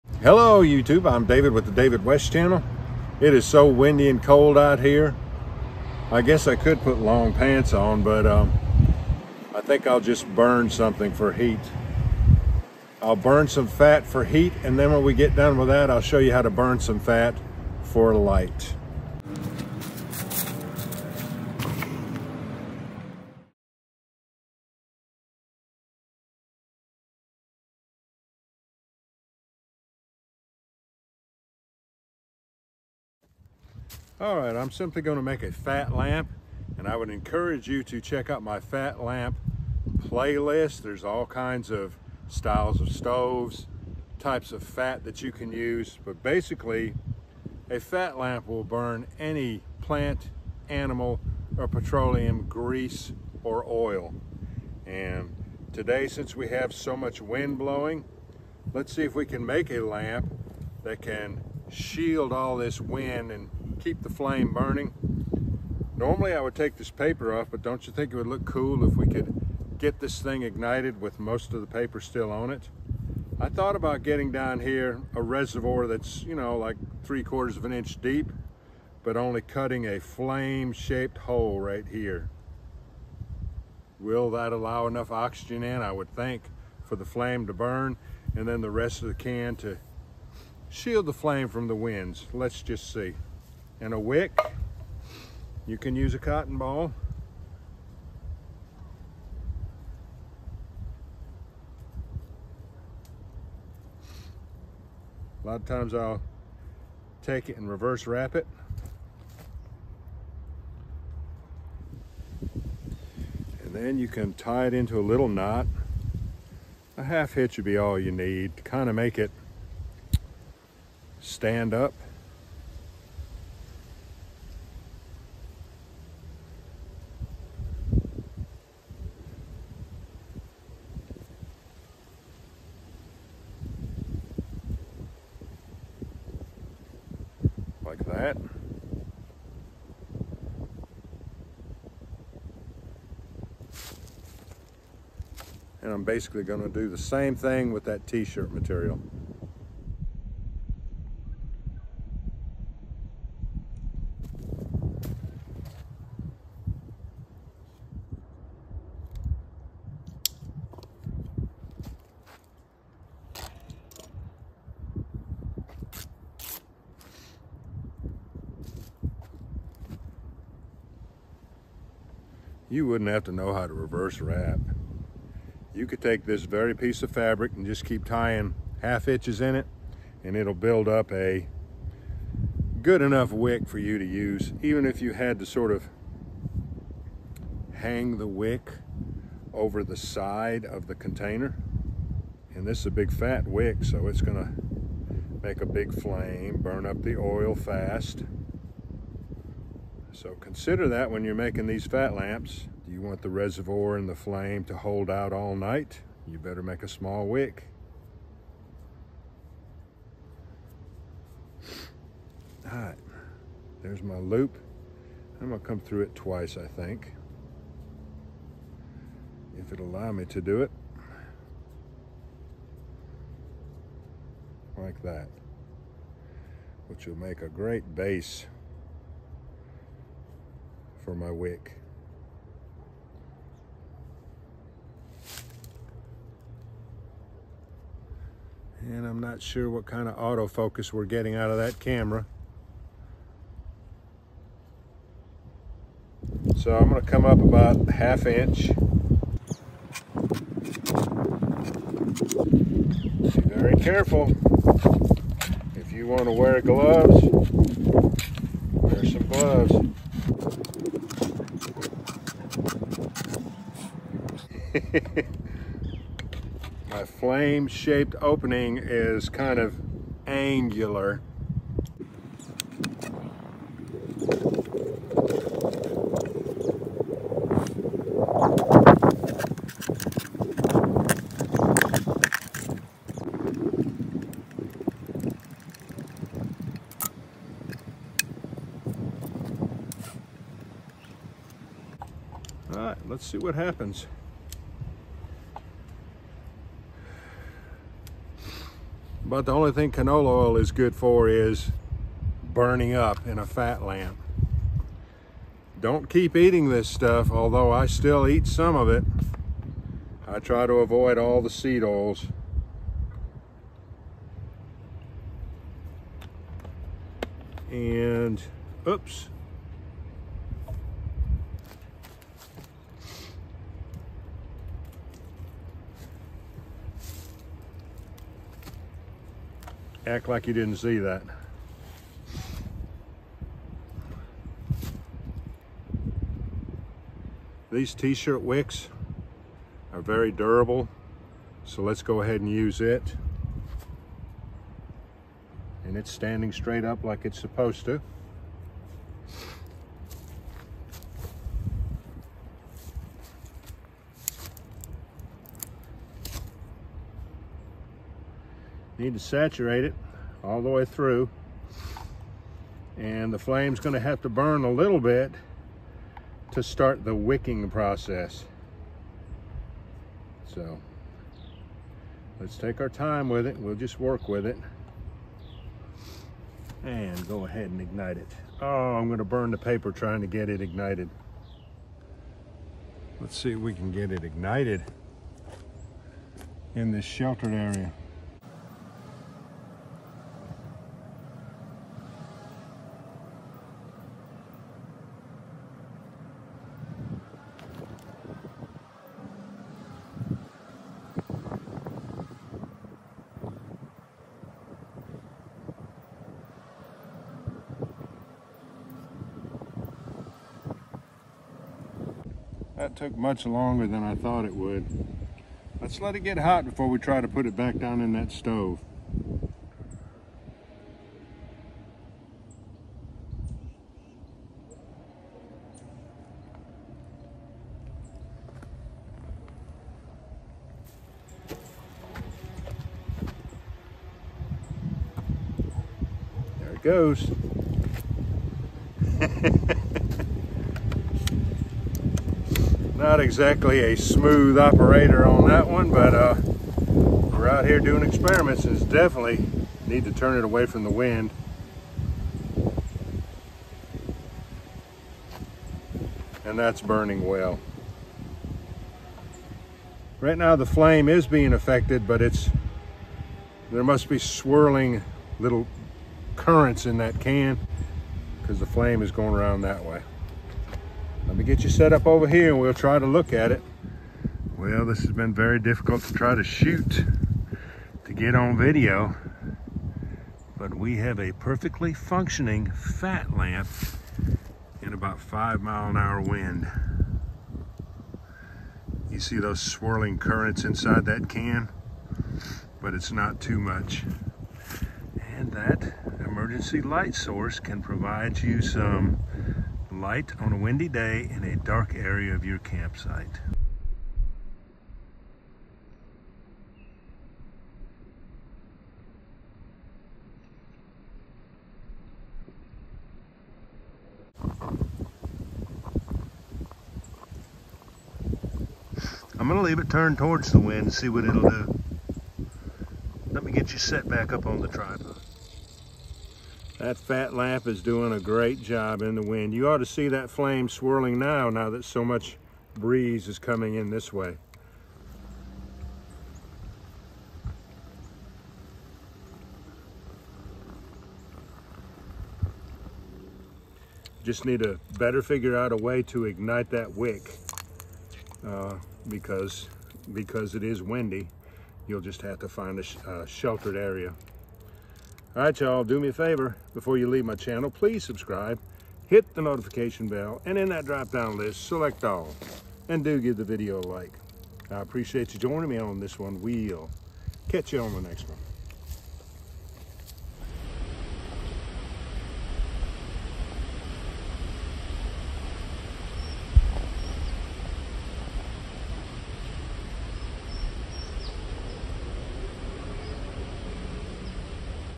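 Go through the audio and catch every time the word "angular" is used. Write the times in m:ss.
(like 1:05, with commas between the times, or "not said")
4:30.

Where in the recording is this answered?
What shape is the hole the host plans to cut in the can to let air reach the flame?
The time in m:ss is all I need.
1:19.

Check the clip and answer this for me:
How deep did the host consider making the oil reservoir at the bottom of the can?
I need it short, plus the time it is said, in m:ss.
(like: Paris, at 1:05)
three quarters of an inch, at 1:17.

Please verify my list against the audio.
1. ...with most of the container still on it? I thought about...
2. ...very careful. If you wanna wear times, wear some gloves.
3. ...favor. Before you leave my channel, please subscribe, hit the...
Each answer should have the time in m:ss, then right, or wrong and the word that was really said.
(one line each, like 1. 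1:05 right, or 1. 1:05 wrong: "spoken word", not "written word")
1. 1:11 wrong: "paper", not "container"
2. 4:13 wrong: "gloves", not "times"
3. 9:16 right.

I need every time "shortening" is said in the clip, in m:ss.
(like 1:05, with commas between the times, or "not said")
not said.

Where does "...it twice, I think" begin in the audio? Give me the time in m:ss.
3:36.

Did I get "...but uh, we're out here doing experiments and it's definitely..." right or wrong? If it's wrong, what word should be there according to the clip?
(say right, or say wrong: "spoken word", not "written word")
right.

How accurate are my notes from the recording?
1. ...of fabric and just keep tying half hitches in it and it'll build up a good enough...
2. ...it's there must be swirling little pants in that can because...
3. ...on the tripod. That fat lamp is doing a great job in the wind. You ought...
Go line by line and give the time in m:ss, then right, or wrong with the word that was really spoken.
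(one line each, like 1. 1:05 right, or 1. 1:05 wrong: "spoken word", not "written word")
1. 2:57 right
2. 7:42 wrong: "currents", not "pants"
3. 8:44 right.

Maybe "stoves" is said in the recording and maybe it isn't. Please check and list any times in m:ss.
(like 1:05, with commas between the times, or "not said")
0:42, 6:58.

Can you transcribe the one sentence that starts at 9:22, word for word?
And do give the video a like.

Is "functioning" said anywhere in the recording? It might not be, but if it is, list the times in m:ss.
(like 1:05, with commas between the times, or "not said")
8:01.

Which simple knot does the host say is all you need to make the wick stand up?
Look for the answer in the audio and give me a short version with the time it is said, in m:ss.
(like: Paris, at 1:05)
half hitch, at 1:57.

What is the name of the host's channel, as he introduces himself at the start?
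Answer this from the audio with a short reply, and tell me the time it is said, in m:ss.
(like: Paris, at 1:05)
David West channel, at 0:01.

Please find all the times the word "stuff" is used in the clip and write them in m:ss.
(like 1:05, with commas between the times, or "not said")
5:06.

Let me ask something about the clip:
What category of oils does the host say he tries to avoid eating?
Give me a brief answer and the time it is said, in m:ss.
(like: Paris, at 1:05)
seed oils, at 5:11.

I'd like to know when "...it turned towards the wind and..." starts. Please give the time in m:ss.
8:39.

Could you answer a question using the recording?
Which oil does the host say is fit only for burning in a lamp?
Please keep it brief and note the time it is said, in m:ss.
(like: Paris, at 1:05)
canola oil, at 4:59.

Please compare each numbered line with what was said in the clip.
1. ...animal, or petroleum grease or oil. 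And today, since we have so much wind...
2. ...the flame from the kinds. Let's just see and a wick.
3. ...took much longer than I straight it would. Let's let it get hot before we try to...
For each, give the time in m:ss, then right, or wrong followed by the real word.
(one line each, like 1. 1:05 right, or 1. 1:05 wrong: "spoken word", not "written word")
1. 0:50 right
2. 1:31 wrong: "winds", not "kinds"
3. 6:52 wrong: "thought", not "straight".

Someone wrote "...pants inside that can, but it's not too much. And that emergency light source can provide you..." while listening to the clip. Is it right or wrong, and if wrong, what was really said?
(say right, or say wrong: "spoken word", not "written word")
wrong: "currents", not "pants".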